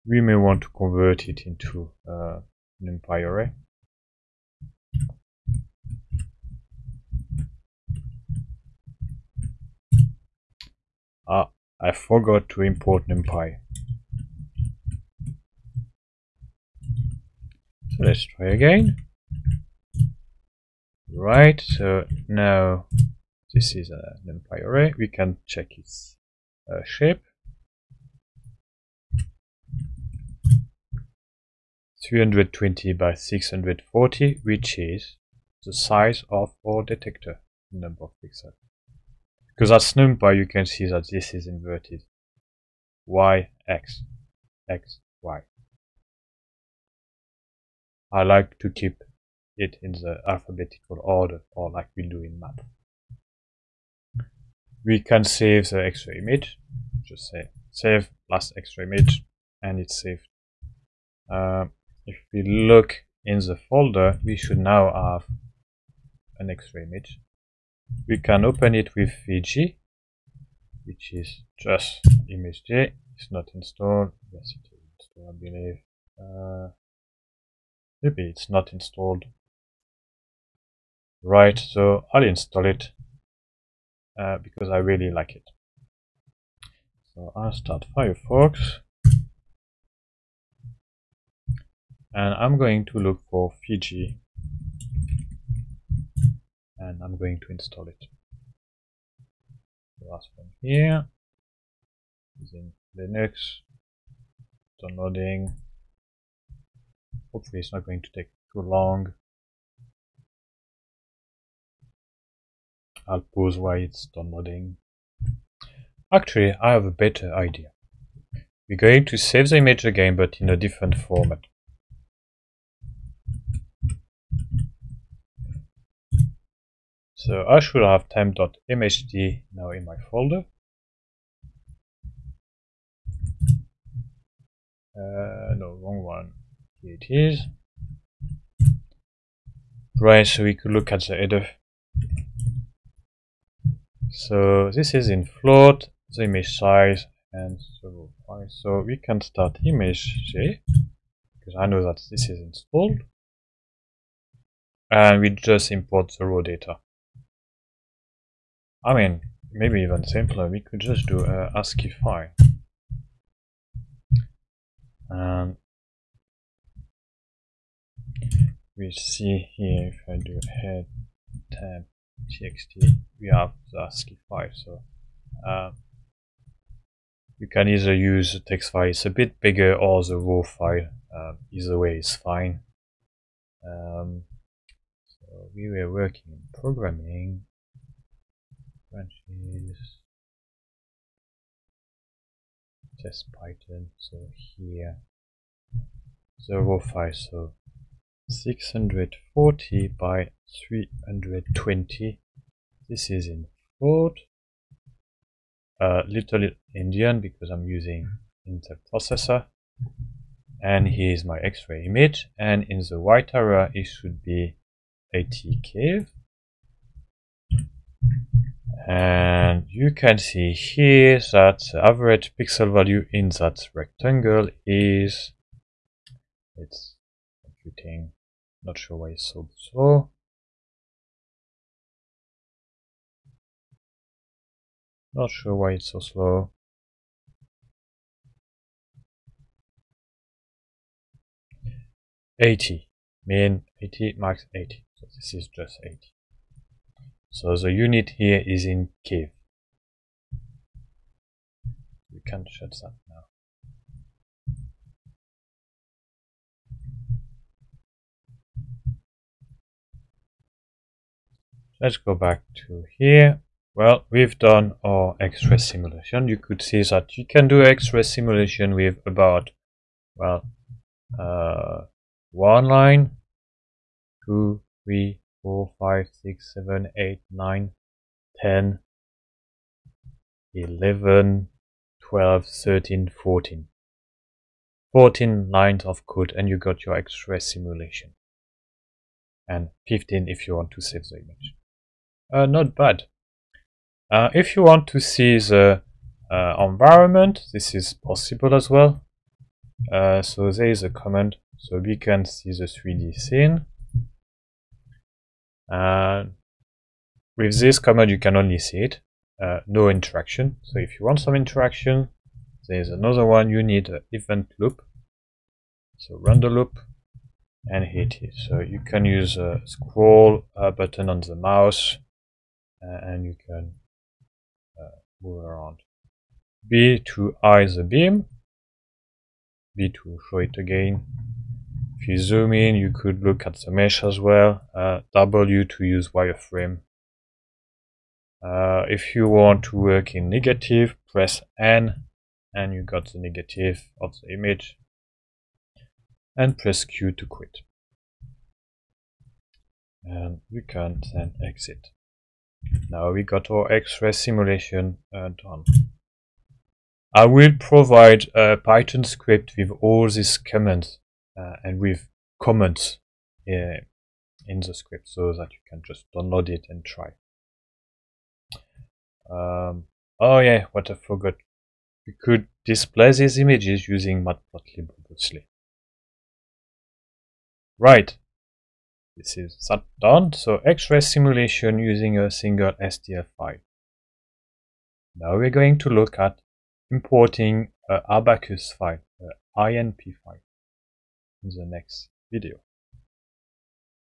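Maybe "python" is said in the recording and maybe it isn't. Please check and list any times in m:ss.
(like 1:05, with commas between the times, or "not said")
3:13, 5:58.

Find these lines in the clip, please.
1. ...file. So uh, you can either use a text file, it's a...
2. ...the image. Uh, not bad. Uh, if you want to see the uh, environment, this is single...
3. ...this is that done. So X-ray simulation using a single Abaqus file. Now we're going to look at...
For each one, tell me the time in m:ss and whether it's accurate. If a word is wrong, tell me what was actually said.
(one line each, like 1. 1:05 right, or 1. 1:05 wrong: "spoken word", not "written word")
1. 2:54 right
2. 4:51 wrong: "possible", not "single"
3. 6:19 wrong: "STL", not "Abaqus".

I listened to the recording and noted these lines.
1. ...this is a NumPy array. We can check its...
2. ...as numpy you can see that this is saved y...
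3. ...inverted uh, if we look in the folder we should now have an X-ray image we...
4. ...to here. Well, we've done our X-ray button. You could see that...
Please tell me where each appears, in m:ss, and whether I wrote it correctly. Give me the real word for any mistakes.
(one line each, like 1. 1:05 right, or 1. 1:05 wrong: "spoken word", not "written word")
1. 0:23 right
2. 0:39 wrong: "inverted", not "saved"
3. 1:00 wrong: "saved", not "inverted"
4. 4:22 wrong: "simulation", not "button".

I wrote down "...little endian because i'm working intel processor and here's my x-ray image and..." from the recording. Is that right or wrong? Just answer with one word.
wrong.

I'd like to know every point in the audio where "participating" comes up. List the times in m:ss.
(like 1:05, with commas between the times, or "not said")
not said.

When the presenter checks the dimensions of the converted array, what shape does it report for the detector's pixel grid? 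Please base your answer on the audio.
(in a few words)
320 by 640.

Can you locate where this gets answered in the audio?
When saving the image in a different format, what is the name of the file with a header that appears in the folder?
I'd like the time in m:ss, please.
2:08.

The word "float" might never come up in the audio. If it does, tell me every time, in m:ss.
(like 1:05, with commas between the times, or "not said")
2:25, 3:23.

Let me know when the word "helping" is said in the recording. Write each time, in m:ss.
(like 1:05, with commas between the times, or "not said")
not said.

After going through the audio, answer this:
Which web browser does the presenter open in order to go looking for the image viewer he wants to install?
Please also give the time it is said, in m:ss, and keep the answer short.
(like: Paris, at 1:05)
Firefox, at 1:27.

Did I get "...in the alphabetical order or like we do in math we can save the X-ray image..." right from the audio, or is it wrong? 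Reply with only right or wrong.
right.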